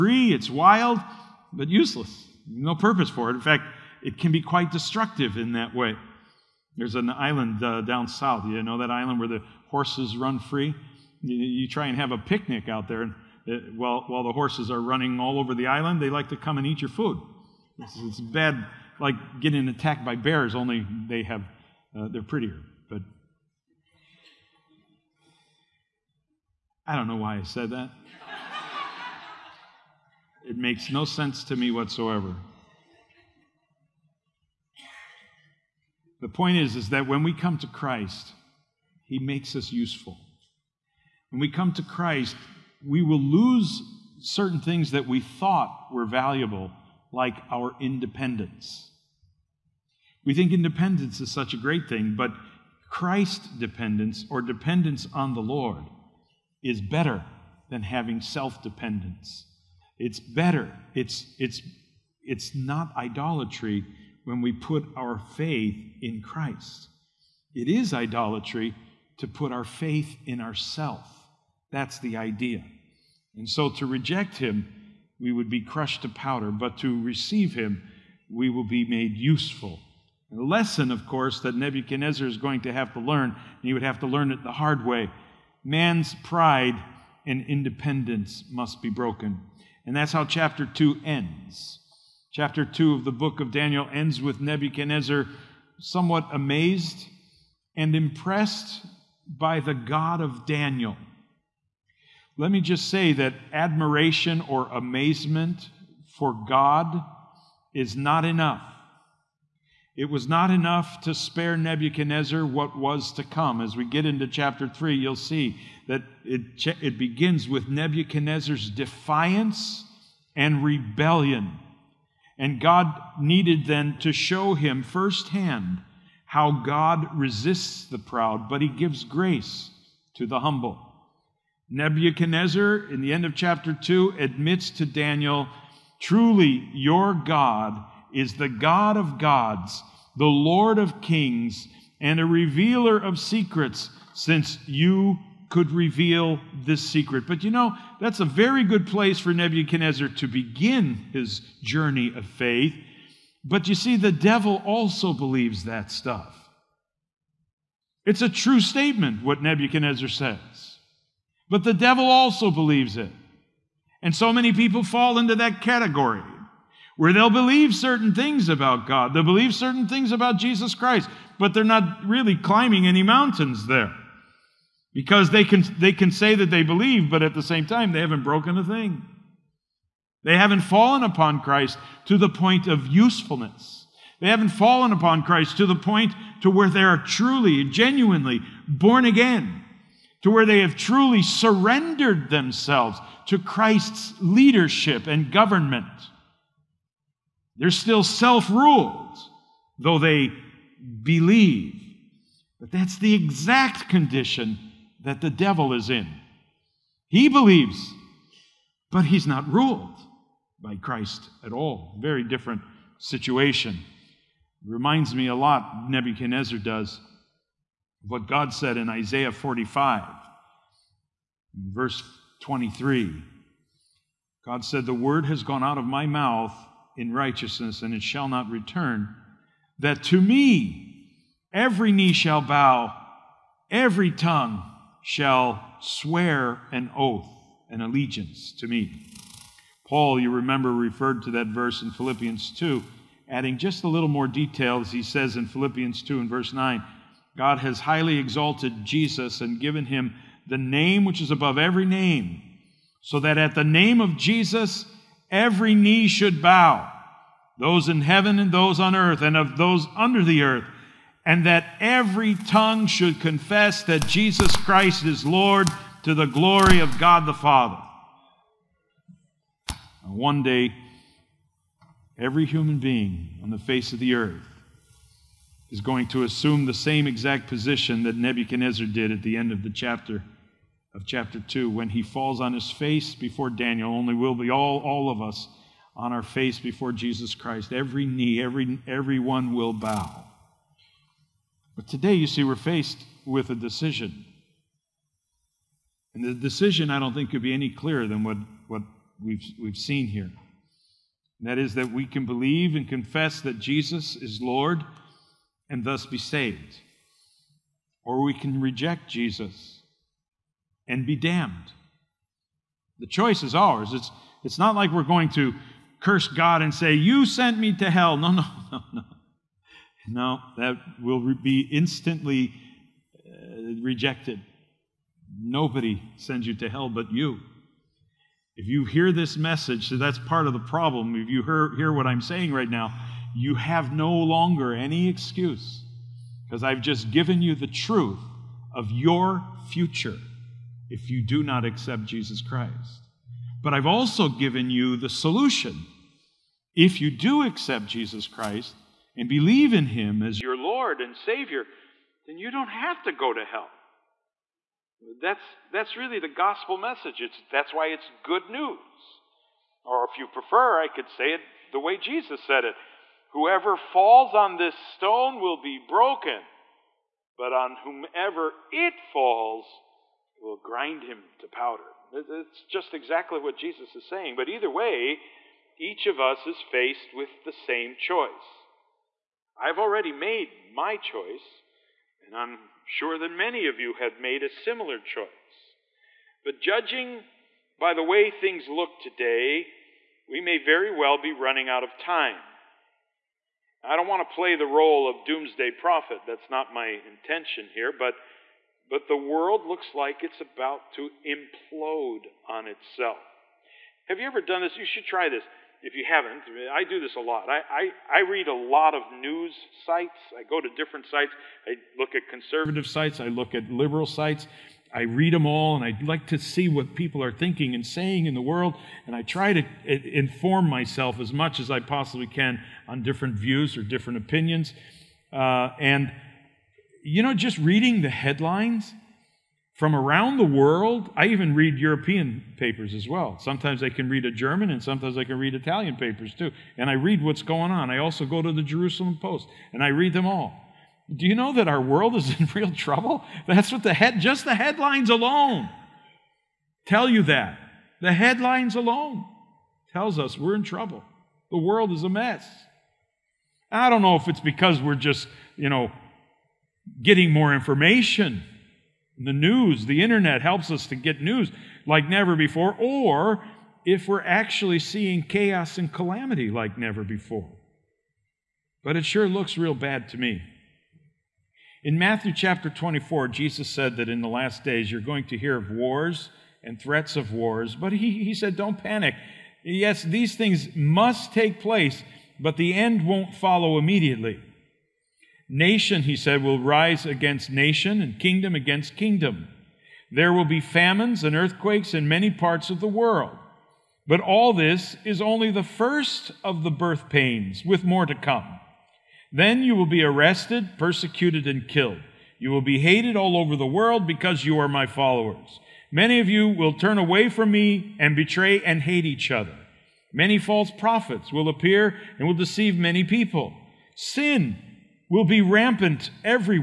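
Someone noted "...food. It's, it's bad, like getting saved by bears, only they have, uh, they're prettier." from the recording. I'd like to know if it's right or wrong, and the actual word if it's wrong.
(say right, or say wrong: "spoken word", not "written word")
wrong: "attacked", not "saved".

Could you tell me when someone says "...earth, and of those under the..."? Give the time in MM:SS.
04:18.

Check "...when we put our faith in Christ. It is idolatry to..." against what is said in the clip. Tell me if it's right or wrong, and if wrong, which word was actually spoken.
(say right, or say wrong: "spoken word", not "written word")
right.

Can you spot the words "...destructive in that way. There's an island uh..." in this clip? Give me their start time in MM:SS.
00:04.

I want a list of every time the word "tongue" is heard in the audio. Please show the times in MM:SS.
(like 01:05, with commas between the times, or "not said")
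03:54, 04:22.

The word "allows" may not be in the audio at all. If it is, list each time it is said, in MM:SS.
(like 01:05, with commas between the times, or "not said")
not said.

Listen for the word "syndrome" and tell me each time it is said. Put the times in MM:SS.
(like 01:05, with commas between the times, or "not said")
not said.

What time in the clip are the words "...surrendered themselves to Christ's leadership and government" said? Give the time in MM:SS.
03:11.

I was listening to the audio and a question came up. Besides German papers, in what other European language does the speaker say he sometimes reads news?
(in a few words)
Italian.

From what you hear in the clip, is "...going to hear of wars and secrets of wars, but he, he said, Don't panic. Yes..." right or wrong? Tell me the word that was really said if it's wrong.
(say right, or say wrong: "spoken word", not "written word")
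wrong: "threats", not "secrets".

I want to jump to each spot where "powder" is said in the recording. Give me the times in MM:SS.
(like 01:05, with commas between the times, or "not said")
01:16, 06:11.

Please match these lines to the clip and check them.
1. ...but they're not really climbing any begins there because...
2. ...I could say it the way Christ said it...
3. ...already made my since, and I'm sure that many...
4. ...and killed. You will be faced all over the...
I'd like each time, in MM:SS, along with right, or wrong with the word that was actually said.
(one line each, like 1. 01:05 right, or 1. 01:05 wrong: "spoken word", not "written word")
1. 02:51 wrong: "mountains", not "begins"
2. 06:00 wrong: "Jesus", not "Christ"
3. 06:19 wrong: "choice", not "since"
4. 08:21 wrong: "hated", not "faced".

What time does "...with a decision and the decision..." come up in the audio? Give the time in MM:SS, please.
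04:53.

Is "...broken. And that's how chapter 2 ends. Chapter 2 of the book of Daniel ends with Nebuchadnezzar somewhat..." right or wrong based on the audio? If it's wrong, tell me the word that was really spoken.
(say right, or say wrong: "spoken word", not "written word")
right.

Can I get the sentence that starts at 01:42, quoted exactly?
Let me just say that admiration or amazement for God is not enough.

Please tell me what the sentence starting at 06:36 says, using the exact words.
That's not my intention here, but, but the world looks like it's about to implode on itself.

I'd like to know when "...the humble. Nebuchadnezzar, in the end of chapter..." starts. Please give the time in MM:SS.
02:10.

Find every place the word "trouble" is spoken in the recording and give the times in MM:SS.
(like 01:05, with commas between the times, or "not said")
07:22, 07:30.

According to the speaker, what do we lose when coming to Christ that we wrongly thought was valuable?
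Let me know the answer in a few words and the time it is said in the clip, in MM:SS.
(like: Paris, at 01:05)
Our independence, at 00:47.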